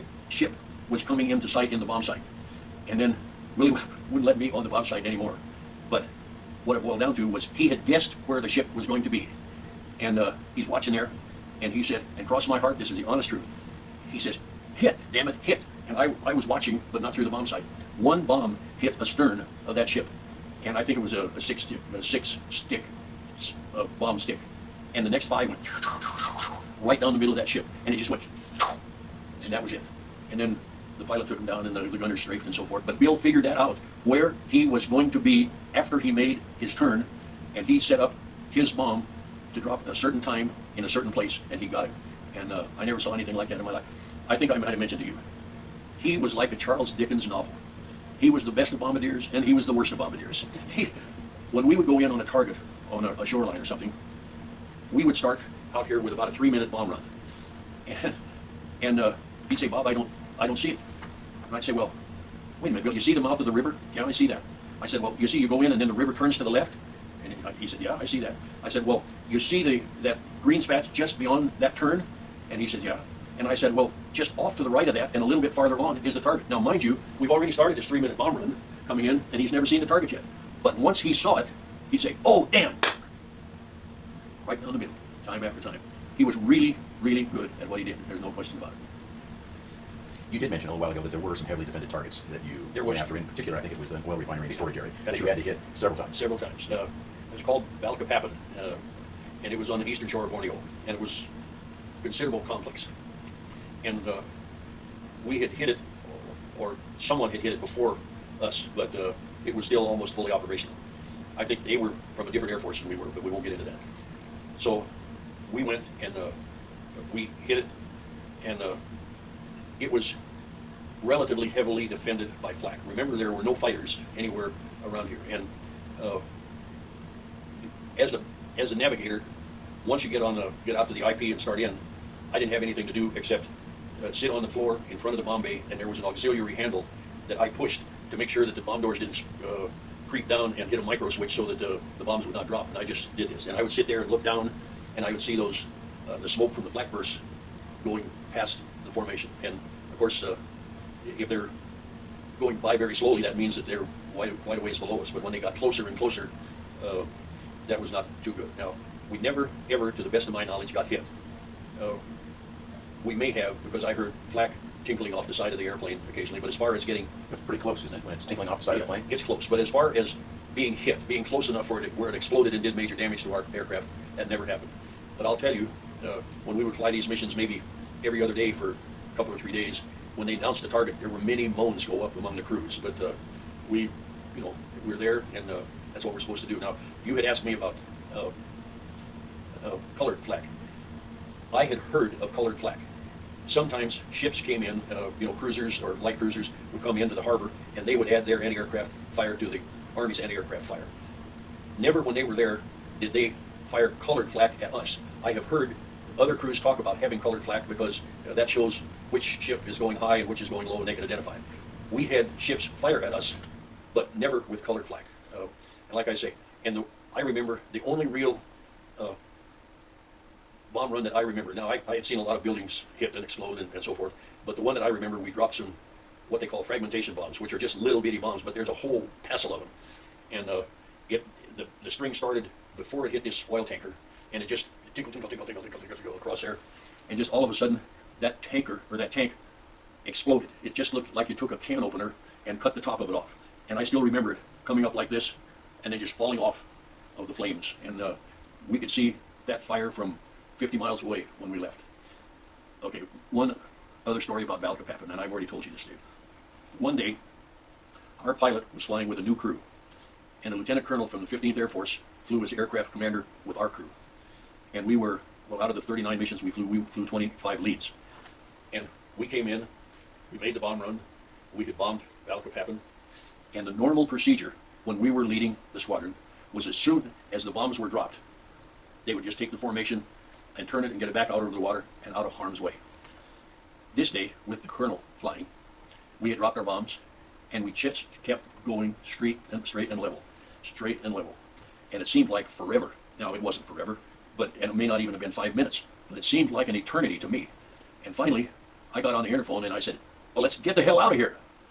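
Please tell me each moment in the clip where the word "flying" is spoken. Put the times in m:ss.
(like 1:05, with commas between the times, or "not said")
4:18, 4:45.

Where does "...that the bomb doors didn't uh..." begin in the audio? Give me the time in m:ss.
2:18.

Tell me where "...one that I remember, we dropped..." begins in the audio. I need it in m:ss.
3:44.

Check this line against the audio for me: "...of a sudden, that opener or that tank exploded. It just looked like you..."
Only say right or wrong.
wrong.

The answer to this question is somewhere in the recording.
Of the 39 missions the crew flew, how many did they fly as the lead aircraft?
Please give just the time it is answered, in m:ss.
4:27.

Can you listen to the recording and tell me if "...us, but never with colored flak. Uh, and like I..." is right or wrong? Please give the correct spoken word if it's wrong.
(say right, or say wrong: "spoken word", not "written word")
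right.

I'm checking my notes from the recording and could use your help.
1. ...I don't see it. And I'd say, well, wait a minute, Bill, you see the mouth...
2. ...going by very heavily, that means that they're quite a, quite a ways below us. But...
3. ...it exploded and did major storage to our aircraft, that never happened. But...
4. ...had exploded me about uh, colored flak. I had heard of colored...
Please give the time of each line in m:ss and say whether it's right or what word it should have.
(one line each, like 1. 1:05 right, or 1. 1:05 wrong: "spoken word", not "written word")
1. 1:00 right
2. 2:32 wrong: "slowly", not "heavily"
3. 2:52 wrong: "damage", not "storage"
4. 3:07 wrong: "asked", not "exploded".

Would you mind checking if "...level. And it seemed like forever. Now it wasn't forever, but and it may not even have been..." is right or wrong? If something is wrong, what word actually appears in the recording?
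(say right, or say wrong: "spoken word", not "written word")
right.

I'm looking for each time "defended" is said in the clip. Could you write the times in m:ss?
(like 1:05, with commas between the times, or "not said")
1:31, 2:01.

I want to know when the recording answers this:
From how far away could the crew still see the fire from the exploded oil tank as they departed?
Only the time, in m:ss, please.
4:10.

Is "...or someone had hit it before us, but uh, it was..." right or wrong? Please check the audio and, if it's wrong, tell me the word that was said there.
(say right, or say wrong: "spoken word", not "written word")
right.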